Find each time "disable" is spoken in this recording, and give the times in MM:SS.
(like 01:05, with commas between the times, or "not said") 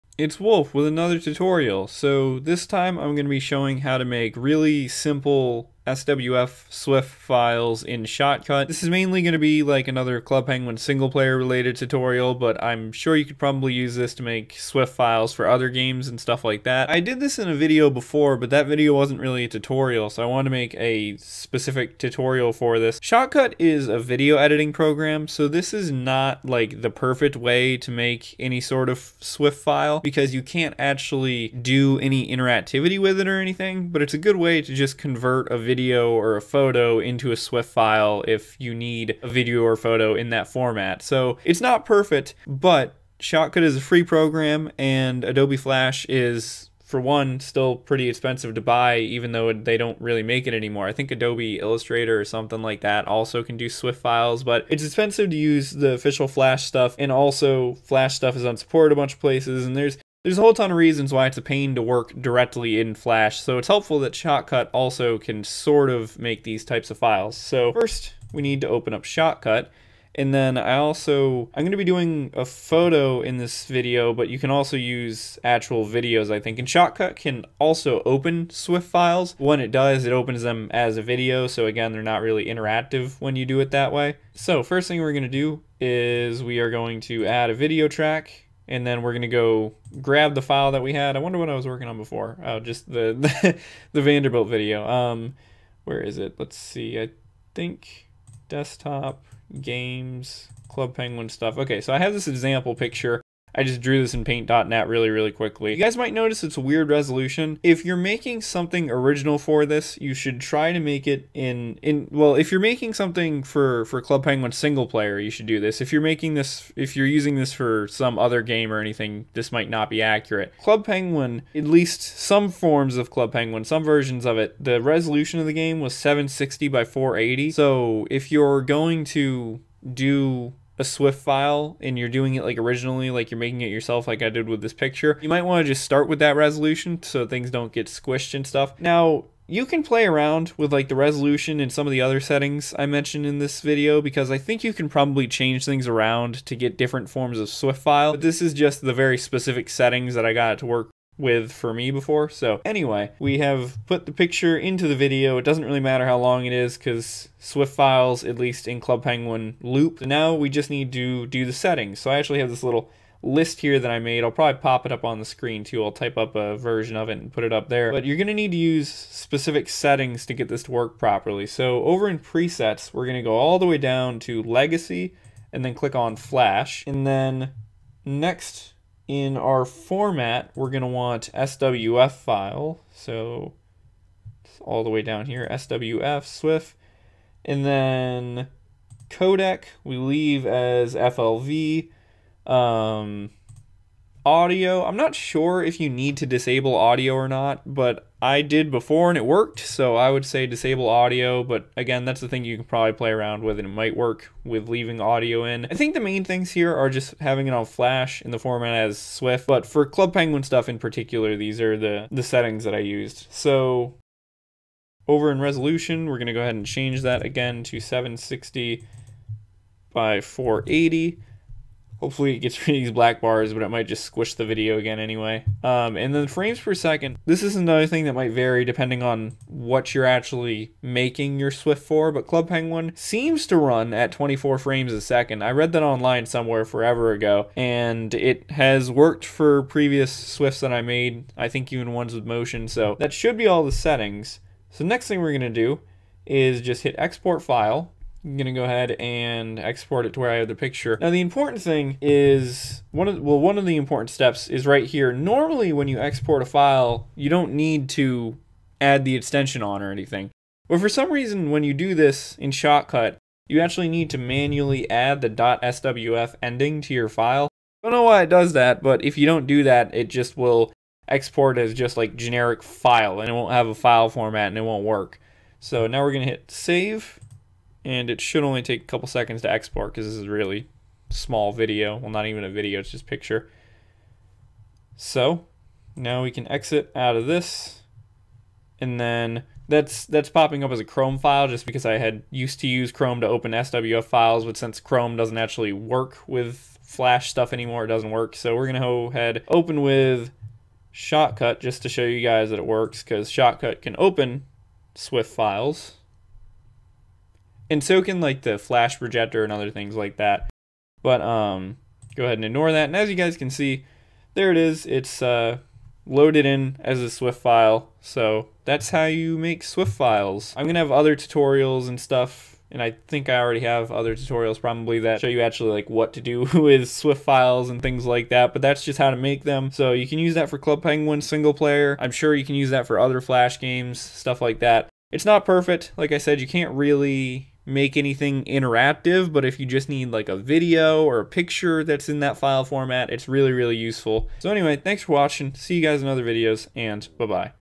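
03:16, 03:20.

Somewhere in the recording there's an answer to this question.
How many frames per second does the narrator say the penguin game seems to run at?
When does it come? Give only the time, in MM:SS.
03:54.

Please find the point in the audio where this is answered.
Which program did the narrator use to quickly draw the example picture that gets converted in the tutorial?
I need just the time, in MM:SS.
01:44.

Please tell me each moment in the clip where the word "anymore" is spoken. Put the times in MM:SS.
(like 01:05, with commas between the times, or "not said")
00:50, 04:57.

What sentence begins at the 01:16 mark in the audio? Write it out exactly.
And Shotcut can also open Swift files.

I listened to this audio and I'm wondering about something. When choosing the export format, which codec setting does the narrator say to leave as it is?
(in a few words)
FLV.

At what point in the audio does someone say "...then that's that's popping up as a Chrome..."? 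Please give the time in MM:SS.
04:48.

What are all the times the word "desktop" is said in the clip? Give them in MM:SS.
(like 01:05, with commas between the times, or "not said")
01:38.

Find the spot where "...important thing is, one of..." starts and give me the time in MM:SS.
04:11.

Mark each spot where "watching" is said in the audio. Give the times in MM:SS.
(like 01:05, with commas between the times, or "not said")
05:45.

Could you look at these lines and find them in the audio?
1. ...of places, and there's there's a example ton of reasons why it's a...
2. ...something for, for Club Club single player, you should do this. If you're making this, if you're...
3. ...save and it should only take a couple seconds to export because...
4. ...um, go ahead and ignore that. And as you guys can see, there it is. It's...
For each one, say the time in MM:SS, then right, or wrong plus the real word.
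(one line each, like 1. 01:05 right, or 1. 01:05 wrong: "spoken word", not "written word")
1. 00:59 wrong: "whole", not "example"
2. 01:52 wrong: "Penguin", not "Club"
3. 04:36 right
4. 05:11 right.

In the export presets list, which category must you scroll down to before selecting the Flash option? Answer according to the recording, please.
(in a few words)
legacy.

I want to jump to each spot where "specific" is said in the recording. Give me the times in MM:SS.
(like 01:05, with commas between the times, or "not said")
00:21, 02:29, 02:48.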